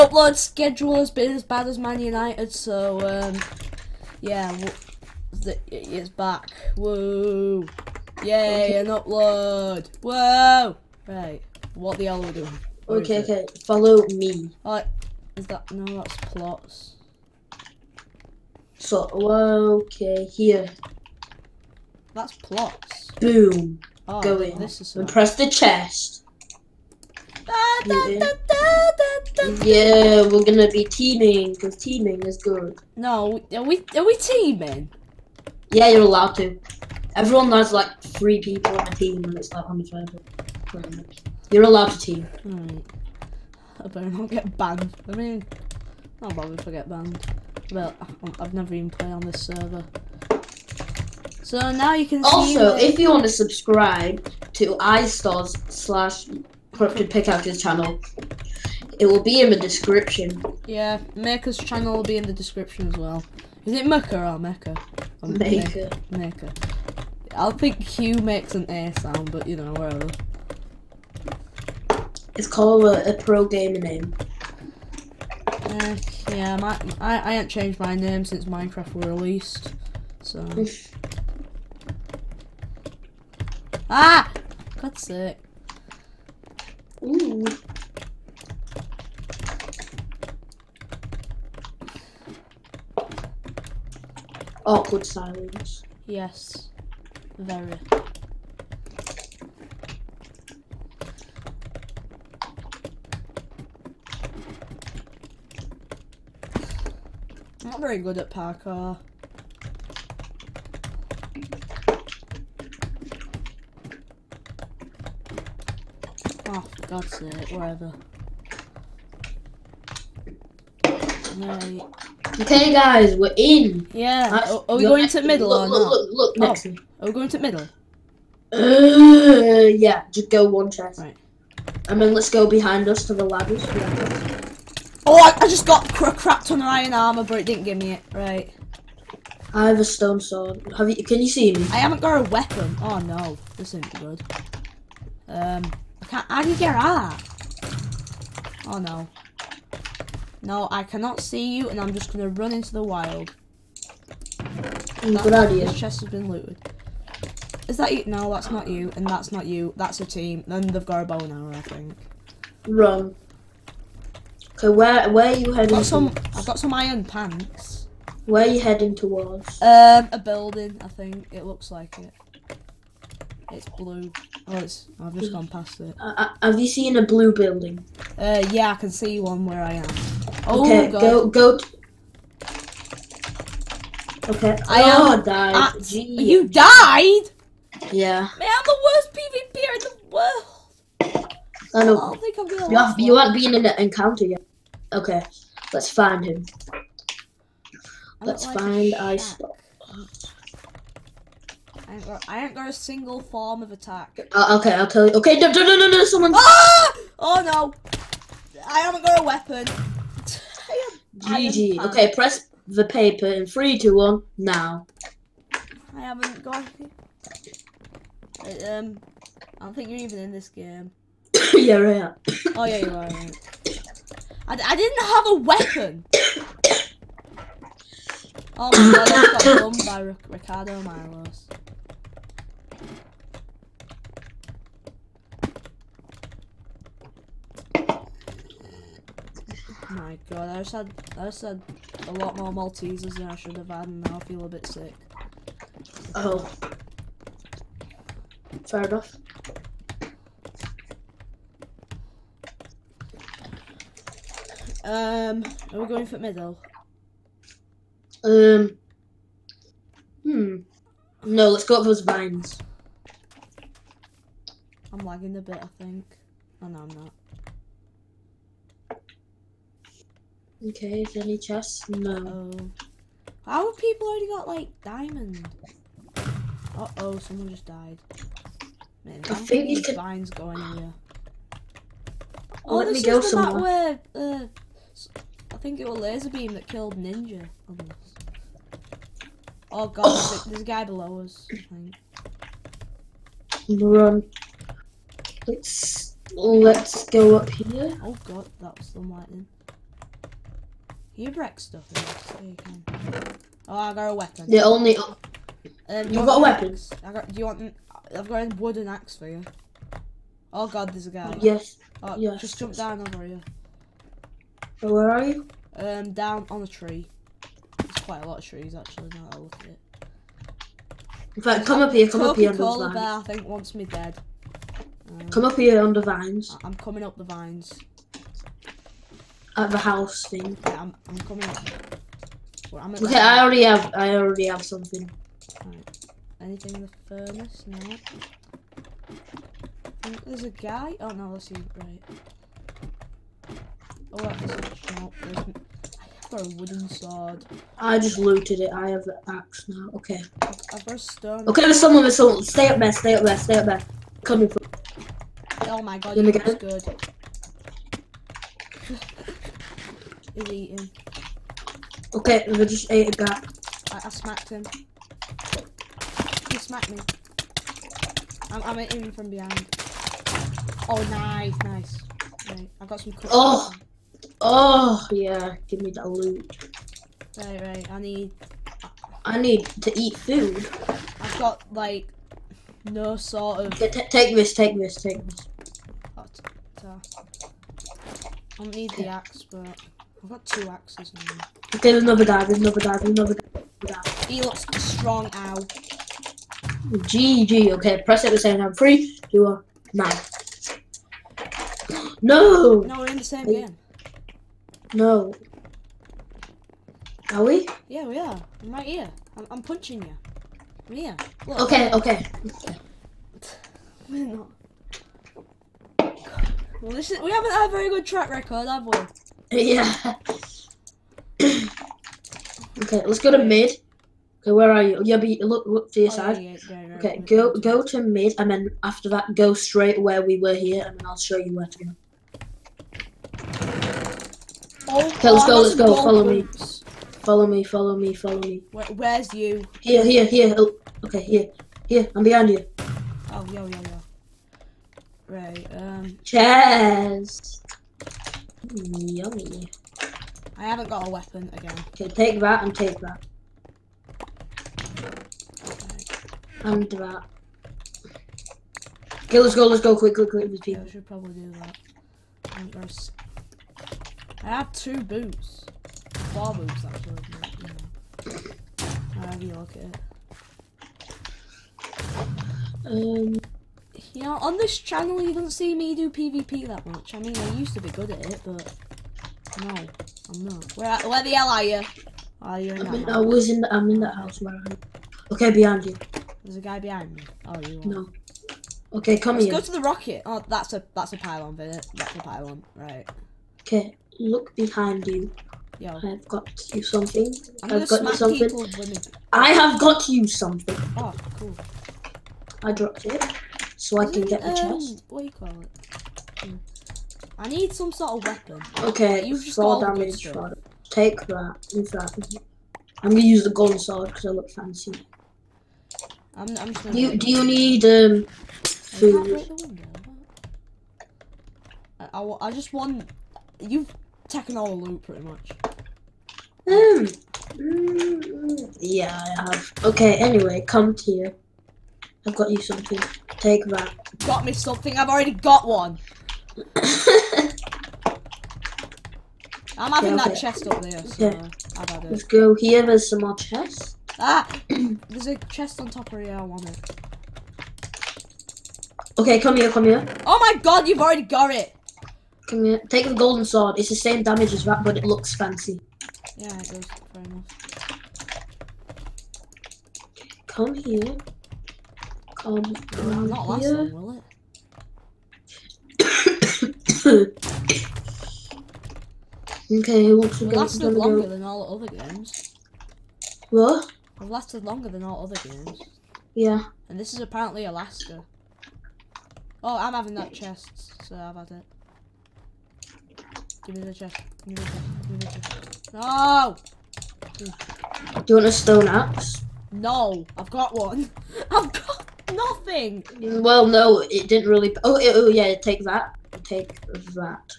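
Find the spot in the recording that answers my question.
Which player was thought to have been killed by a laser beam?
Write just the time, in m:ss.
4:46.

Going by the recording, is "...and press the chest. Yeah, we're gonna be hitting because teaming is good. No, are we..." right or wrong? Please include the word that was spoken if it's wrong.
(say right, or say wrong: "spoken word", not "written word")
wrong: "teaming", not "hitting".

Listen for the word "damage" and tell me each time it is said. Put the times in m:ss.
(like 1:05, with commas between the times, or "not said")
8:29, 9:14.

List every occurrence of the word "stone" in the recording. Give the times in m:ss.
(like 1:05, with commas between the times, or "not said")
2:19, 5:50, 9:48.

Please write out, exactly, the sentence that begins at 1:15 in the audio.
Uh, yeah, my, I, I haven't changed my name since Minecraft were released, so...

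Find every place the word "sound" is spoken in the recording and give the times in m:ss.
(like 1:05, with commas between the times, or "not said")
1:08.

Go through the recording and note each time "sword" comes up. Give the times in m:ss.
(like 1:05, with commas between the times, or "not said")
2:20, 5:46, 8:33, 9:13.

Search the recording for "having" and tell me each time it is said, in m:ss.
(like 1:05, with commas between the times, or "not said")
8:59, 9:39.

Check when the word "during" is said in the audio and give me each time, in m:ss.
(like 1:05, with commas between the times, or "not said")
not said.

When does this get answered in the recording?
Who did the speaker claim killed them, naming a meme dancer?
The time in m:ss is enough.
3:50.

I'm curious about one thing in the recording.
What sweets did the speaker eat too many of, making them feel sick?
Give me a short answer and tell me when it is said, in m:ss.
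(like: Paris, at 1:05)
Maltesers, at 4:02.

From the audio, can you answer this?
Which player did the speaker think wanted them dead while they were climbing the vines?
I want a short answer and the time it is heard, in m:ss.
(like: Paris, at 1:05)
coca bear, at 5:22.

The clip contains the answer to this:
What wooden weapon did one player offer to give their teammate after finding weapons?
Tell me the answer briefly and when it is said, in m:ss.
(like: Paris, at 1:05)
wooden axe, at 5:08.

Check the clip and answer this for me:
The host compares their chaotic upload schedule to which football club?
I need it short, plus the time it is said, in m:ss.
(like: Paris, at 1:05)
Man United, at 0:01.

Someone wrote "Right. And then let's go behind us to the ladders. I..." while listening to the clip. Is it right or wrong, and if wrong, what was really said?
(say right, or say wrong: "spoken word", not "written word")
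right.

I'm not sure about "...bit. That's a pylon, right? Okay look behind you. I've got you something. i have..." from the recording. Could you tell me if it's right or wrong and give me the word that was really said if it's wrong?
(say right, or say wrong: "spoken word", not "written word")
right.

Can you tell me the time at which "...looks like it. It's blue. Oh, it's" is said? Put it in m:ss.
2:51.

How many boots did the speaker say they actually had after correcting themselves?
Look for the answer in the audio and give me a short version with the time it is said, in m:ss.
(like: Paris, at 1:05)
4, at 7:46.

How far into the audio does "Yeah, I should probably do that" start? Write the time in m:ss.
7:40.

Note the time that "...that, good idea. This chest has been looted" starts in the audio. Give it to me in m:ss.
2:35.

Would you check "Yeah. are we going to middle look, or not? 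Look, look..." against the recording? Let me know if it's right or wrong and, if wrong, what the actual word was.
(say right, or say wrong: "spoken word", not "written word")
right.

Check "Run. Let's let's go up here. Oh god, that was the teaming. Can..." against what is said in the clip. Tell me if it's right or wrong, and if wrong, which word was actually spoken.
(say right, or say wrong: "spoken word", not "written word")
wrong: "lightning", not "teaming".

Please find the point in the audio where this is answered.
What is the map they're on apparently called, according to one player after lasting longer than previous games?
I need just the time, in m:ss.
9:37.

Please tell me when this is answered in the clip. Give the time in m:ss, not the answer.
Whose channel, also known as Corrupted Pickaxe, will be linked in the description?
0:54.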